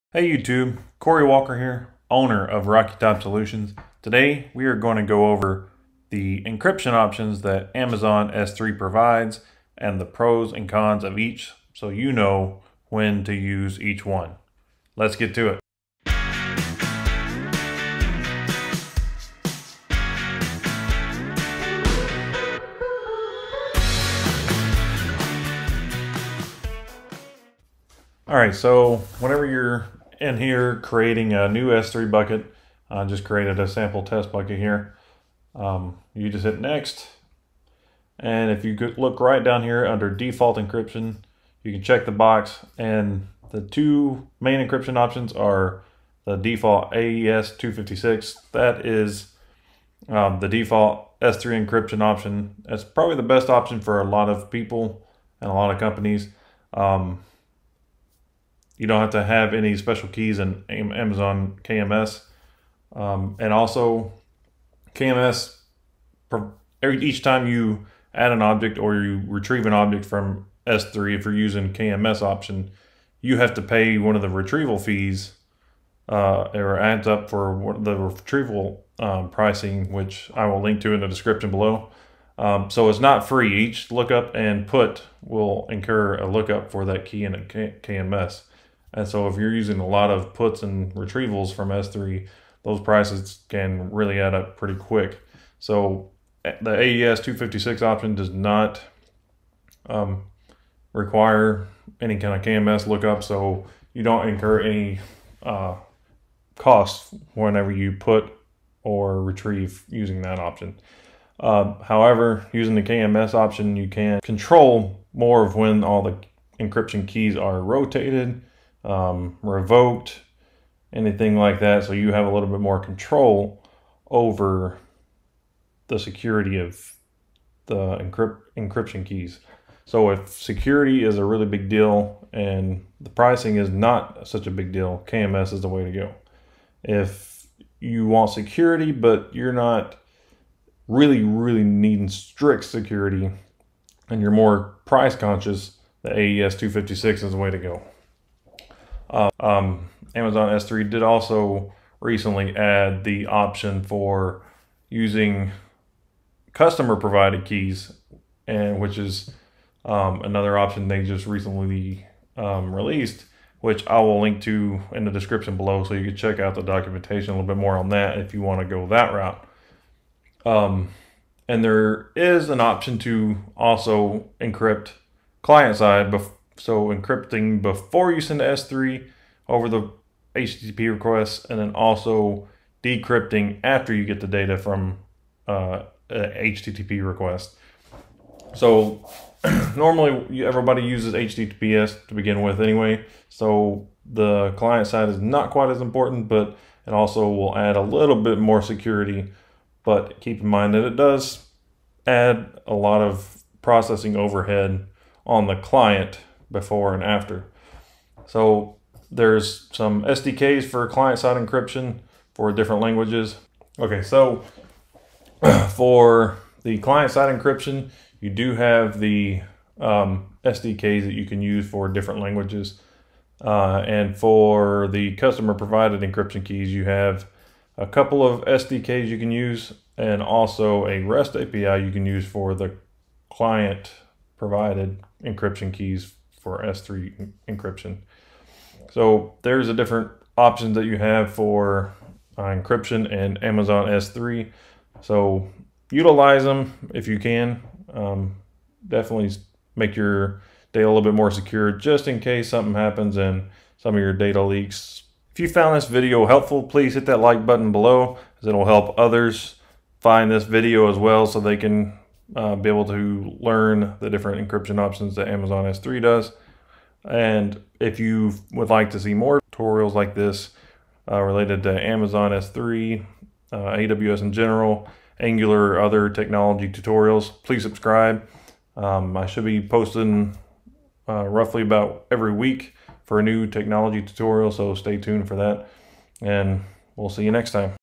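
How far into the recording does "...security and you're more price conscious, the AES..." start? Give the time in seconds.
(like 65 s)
142 s.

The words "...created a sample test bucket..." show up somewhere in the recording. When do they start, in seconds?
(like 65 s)
33 s.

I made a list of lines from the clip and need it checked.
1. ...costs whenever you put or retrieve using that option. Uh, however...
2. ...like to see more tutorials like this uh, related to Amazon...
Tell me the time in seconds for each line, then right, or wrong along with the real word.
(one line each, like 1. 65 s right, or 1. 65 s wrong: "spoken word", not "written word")
1. 106 s right
2. 268 s right.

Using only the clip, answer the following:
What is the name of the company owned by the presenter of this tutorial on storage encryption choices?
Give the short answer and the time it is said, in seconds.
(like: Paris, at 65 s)
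Rocky Top Solutions, at 2 s.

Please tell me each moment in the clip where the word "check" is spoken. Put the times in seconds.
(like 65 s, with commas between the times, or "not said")
41 s, 166 s.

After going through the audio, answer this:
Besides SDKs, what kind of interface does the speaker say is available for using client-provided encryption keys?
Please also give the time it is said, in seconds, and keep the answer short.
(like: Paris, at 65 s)
REST API, at 231 s.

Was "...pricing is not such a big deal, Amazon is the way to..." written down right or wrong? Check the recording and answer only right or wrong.
wrong.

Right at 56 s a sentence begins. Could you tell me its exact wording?
Um, you don't have to have any special keys in Amazon KMS.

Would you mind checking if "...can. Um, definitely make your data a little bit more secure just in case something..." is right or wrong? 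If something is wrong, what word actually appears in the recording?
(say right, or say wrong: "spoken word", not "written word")
right.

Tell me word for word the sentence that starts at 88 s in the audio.
And so if you're using a lot of puts and retrievals from S3, those prices can really add up pretty quick.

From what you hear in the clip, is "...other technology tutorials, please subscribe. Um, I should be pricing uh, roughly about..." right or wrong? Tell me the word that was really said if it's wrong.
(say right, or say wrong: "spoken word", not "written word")
wrong: "posting", not "pricing".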